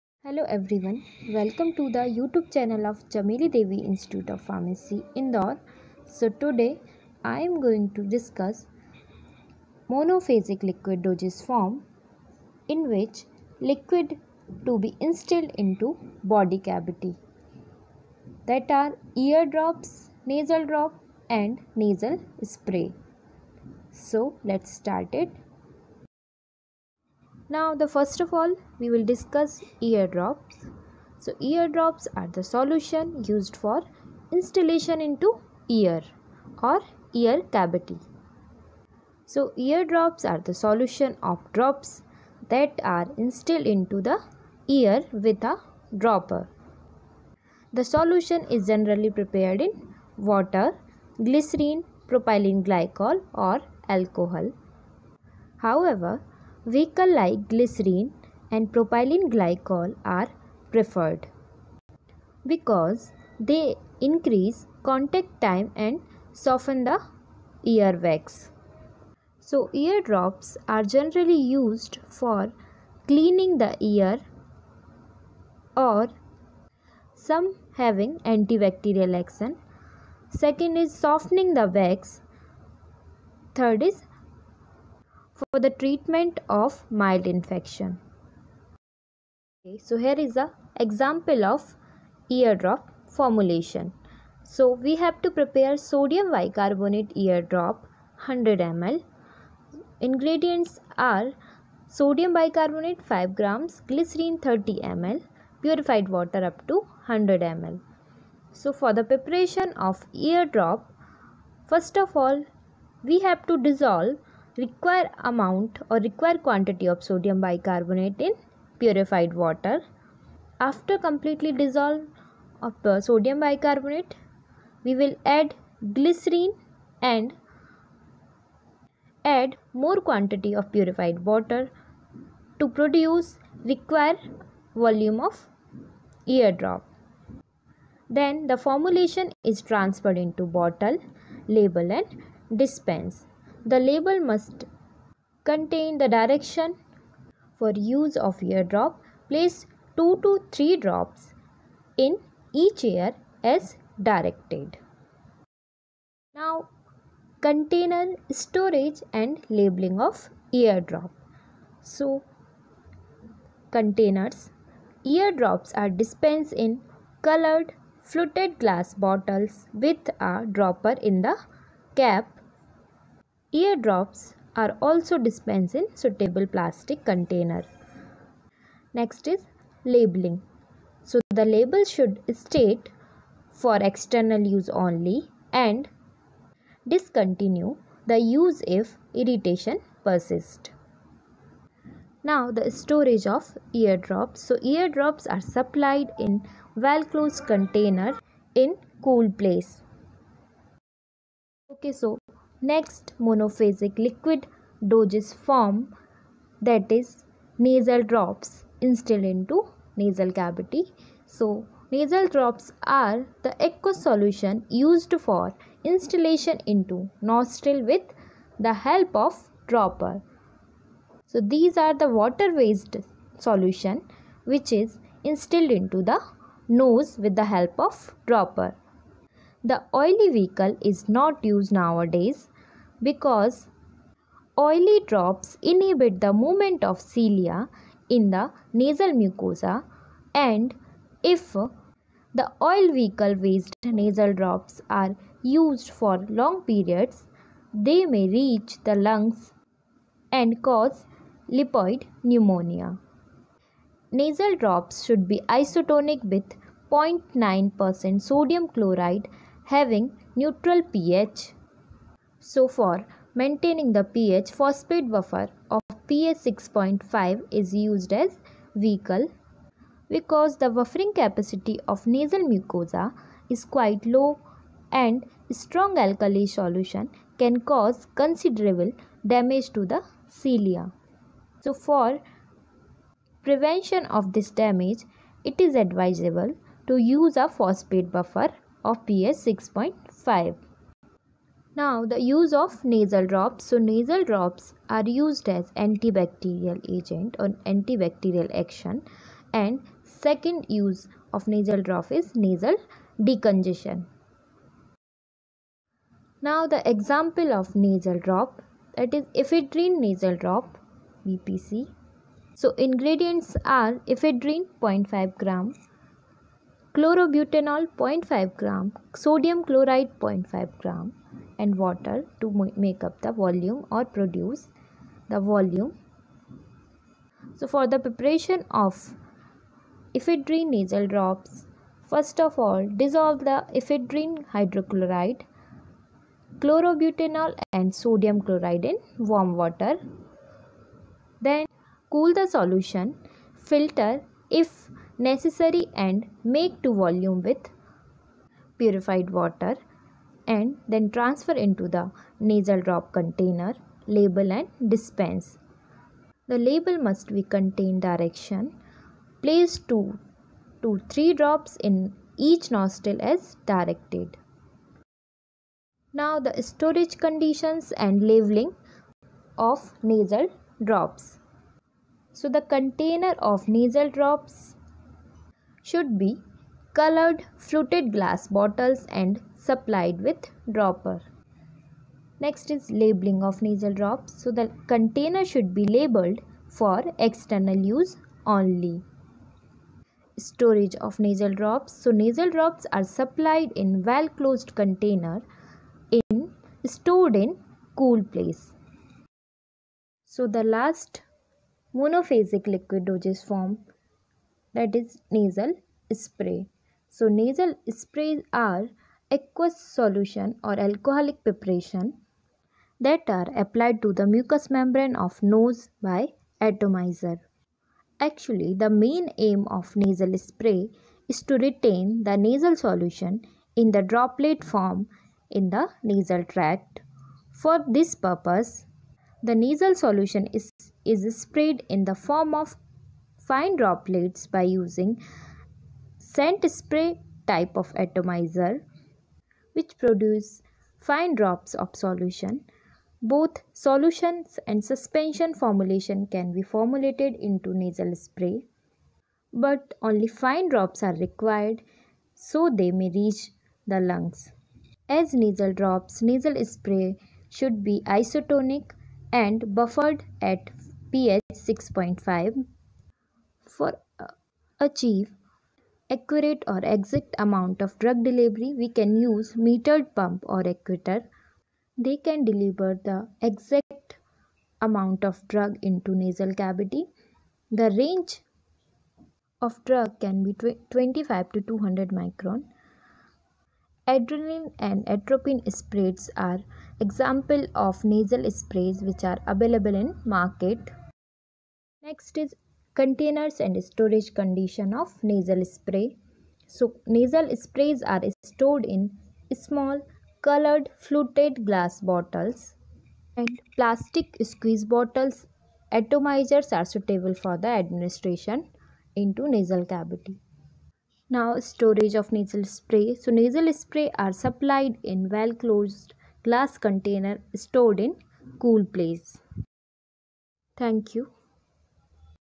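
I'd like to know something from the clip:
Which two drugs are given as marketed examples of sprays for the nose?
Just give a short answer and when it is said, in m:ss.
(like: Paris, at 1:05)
adrenaline and atropine, at 8:04.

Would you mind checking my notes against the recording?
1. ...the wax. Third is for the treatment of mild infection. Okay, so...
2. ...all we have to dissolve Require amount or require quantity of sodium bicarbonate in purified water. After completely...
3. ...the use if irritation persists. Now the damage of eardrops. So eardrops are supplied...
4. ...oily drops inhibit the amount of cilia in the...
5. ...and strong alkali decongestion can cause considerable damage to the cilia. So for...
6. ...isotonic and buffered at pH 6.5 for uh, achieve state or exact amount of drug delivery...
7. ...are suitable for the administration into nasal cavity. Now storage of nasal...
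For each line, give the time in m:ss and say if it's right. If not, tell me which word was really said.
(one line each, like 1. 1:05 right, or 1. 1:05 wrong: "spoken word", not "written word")
1. 1:21 right
2. 1:52 right
3. 3:08 wrong: "storage", not "damage"
4. 3:54 wrong: "movement", not "amount"
5. 4:34 wrong: "solution", not "decongestion"
6. 7:38 wrong: "accurate", not "state"
7. 8:26 right.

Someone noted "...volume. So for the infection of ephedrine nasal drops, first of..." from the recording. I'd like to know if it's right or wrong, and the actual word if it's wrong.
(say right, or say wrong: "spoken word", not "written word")
wrong: "preparation", not "infection".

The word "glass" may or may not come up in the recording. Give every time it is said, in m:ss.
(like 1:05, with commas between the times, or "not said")
2:48, 6:18, 8:21, 8:36.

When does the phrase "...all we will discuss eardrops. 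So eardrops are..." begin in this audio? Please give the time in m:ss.
0:28.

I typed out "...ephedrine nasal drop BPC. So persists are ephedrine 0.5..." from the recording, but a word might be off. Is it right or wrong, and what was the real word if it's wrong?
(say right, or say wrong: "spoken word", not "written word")
wrong: "ingredients", not "persists".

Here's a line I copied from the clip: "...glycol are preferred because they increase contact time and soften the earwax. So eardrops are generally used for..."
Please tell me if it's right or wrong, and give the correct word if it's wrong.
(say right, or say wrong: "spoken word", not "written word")
right.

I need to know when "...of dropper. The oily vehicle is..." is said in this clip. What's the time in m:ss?
3:47.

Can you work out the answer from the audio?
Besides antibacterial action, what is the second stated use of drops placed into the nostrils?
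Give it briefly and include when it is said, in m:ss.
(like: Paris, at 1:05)
nasal decongestion, at 5:02.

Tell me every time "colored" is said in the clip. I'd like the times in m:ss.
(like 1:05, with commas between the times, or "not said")
2:47, 6:16, 8:20.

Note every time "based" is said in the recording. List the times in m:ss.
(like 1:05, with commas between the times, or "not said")
3:42, 4:03.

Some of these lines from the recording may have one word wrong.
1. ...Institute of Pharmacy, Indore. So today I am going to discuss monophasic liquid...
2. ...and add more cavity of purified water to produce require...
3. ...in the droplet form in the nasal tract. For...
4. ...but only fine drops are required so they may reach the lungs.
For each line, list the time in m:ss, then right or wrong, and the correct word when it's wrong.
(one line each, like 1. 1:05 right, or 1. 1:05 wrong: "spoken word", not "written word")
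1. 0:03 right
2. 2:07 wrong: "quantity", not "cavity"
3. 7:03 right
4. 7:29 right.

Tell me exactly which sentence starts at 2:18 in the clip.
Then the formulation is transferred into bottle, label and dispense.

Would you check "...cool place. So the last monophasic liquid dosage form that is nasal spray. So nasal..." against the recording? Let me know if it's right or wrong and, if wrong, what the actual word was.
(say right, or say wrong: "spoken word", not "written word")
right.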